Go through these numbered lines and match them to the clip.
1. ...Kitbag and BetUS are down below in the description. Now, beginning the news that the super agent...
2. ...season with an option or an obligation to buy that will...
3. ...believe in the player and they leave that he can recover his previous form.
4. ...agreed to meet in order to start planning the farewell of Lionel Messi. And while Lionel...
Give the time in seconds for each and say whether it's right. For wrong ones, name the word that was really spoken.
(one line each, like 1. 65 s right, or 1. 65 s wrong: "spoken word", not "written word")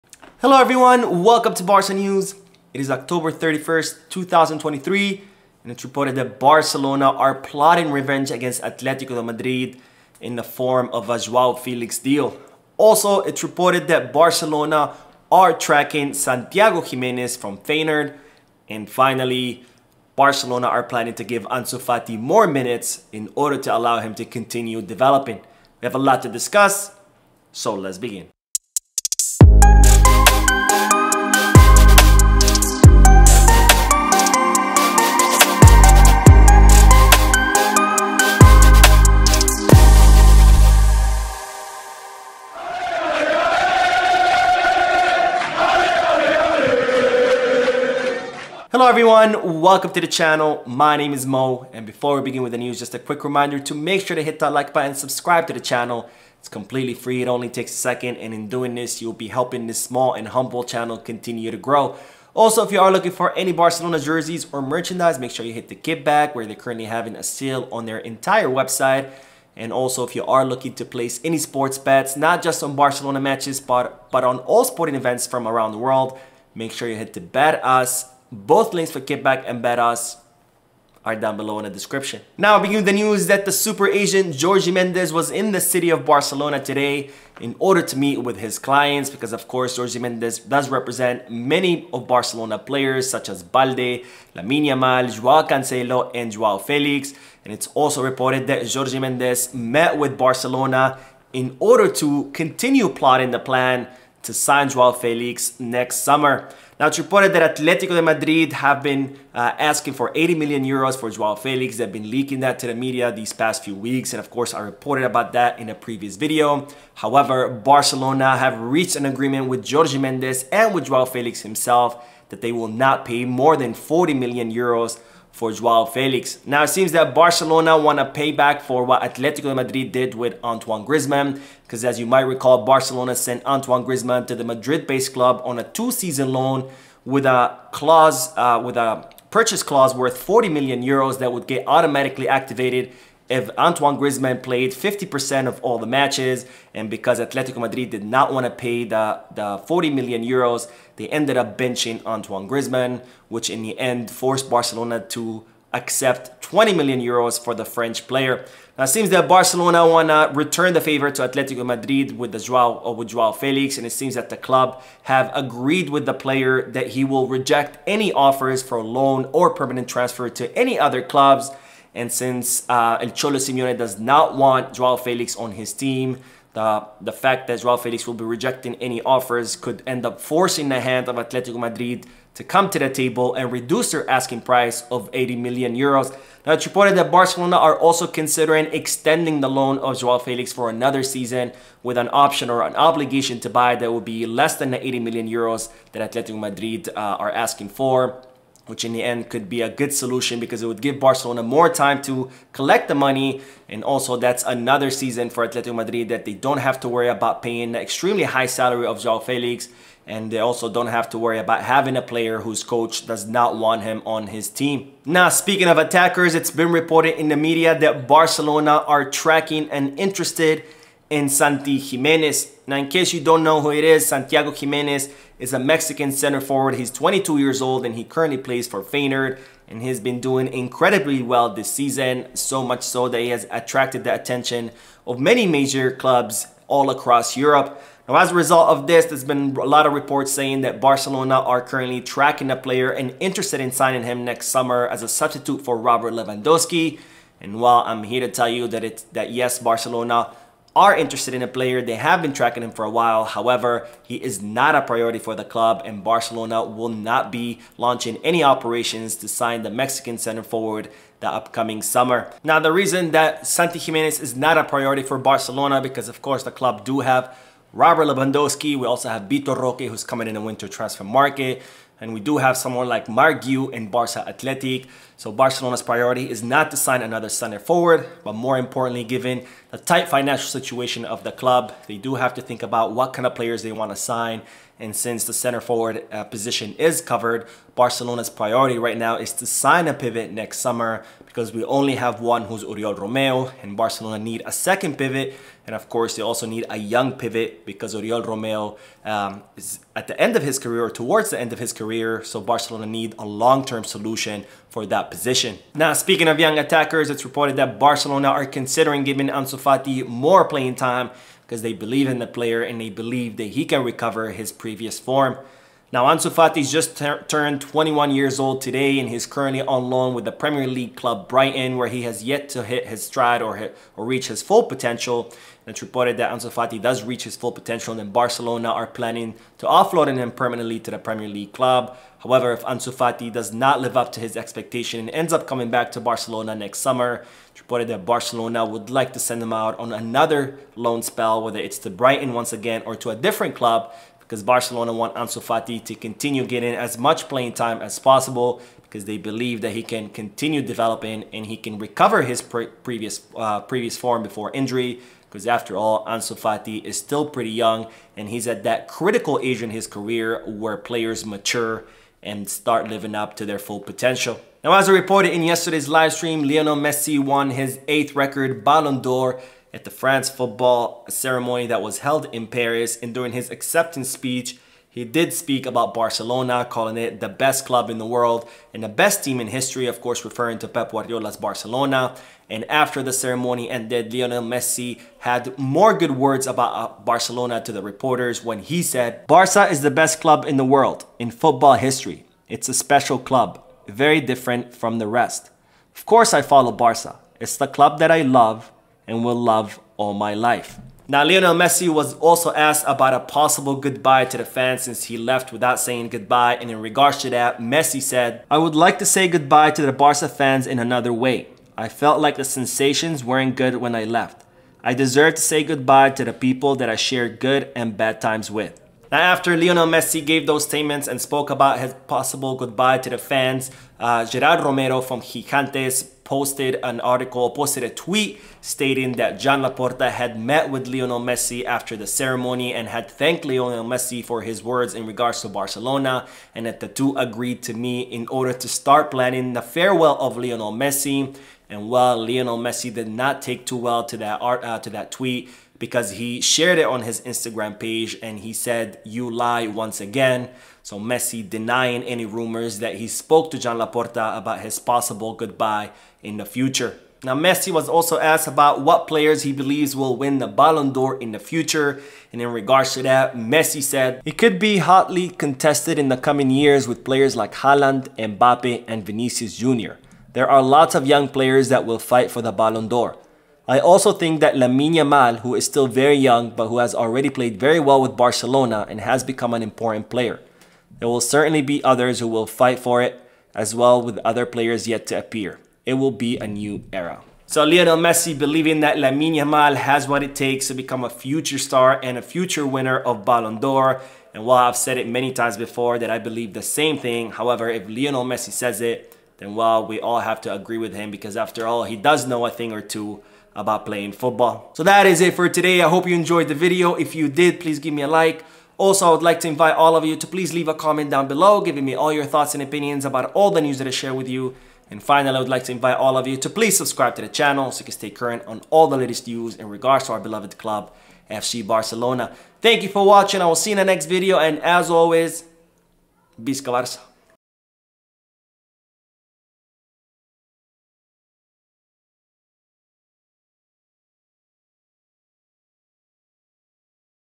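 1. 79 s right
2. 191 s right
3. 311 s wrong: "believe", not "leave"
4. 437 s right.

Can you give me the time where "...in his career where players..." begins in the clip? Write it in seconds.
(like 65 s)
359 s.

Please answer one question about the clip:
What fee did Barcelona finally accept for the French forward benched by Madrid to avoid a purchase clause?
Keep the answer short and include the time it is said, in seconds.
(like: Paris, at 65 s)
20 million euros, at 156 s.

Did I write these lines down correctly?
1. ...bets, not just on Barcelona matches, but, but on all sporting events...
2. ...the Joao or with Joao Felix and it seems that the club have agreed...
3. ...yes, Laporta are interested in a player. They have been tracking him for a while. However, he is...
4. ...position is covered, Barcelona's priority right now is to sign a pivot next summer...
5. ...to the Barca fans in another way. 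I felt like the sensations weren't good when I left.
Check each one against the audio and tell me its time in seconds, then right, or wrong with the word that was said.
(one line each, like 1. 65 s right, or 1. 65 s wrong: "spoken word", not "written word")
1. 71 s right
2. 162 s right
3. 249 s wrong: "Barcelona", not "Laporta"
4. 286 s right
5. 409 s right.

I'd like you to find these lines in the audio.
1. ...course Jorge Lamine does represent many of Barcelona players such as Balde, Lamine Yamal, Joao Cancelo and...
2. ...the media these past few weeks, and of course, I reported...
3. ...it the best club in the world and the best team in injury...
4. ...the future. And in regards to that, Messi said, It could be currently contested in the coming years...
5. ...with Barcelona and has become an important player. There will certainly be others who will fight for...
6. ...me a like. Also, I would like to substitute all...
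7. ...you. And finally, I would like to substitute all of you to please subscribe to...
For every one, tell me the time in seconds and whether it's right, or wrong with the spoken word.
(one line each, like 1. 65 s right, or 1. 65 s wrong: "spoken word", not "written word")
1. 89 s wrong: "Mendes", not "Lamine"
2. 112 s right
3. 376 s wrong: "history", not "injury"
4. 461 s wrong: "hotly", not "currently"
5. 478 s right
6. 507 s wrong: "invite", not "substitute"
7. 514 s wrong: "invite", not "substitute".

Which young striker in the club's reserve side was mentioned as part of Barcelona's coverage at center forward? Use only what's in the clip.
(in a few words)
Marc Guiu.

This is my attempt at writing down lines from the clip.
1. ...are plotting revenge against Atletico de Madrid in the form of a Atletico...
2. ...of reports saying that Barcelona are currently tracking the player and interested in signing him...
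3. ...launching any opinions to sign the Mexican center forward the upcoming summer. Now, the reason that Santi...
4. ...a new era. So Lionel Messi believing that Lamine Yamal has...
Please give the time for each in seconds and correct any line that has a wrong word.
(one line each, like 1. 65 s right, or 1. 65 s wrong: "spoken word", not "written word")
1. 7 s wrong: "Joao", not "Atletico"
2. 239 s right
3. 257 s wrong: "operations", not "opinions"
4. 486 s right.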